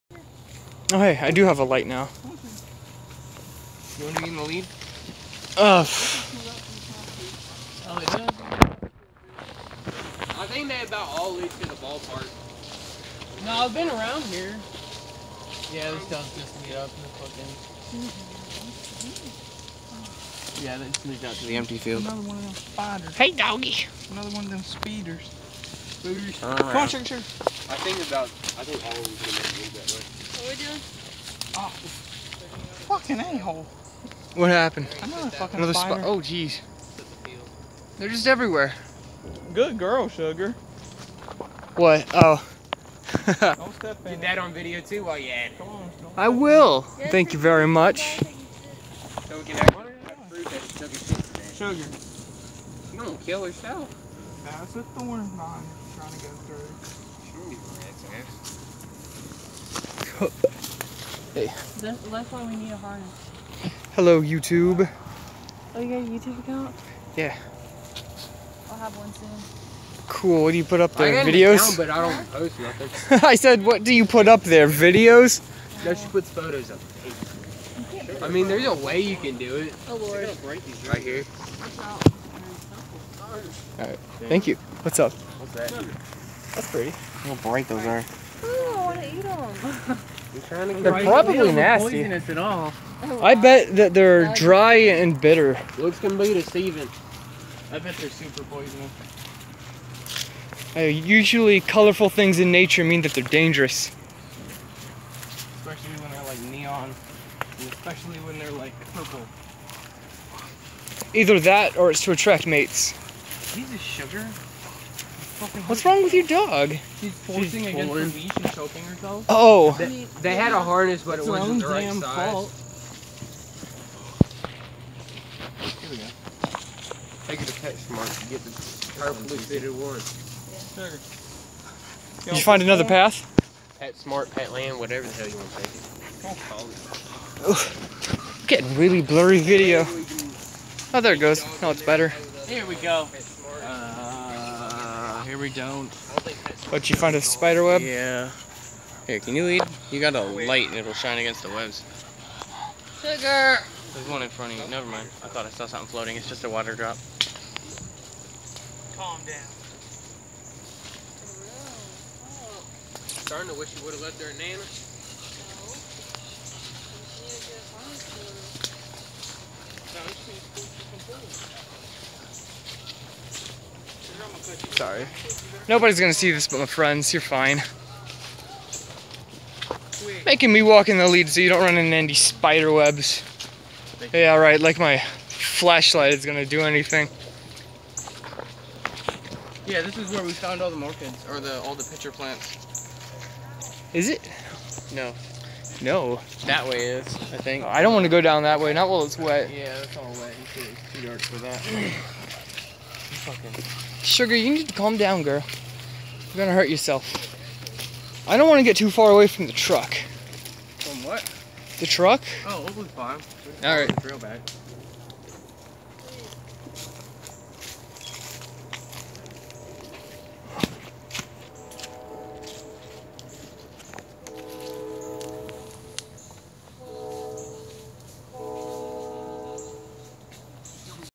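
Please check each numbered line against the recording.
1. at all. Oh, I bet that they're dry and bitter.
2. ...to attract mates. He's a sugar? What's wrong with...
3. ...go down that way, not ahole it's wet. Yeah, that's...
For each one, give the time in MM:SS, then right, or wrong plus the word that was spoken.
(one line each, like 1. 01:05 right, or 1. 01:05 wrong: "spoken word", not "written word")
1. 01:32 right
2. 01:52 right
3. 03:18 wrong: "while", not "ahole".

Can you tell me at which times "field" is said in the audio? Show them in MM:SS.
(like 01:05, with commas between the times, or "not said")
00:21.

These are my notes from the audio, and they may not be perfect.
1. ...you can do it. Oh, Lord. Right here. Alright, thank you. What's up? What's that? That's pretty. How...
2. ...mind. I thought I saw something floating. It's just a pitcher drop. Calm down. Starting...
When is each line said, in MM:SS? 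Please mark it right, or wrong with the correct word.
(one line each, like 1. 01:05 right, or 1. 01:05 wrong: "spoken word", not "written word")
1. 01:18 right
2. 02:34 wrong: "water", not "pitcher".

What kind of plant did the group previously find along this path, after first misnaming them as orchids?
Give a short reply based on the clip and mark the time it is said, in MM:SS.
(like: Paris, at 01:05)
Pitcher plants, at 03:11.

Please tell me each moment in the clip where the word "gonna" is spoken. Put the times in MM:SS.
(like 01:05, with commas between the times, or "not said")
02:55, 03:06, 03:26.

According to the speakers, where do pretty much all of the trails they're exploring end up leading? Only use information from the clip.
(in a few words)
The ballpark.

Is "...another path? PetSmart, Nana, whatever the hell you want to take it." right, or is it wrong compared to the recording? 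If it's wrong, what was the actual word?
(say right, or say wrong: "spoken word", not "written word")
wrong: "Petland", not "Nana".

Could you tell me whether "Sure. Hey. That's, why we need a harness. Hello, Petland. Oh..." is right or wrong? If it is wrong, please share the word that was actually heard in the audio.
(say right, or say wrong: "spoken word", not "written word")
wrong: "YouTube", not "Petland".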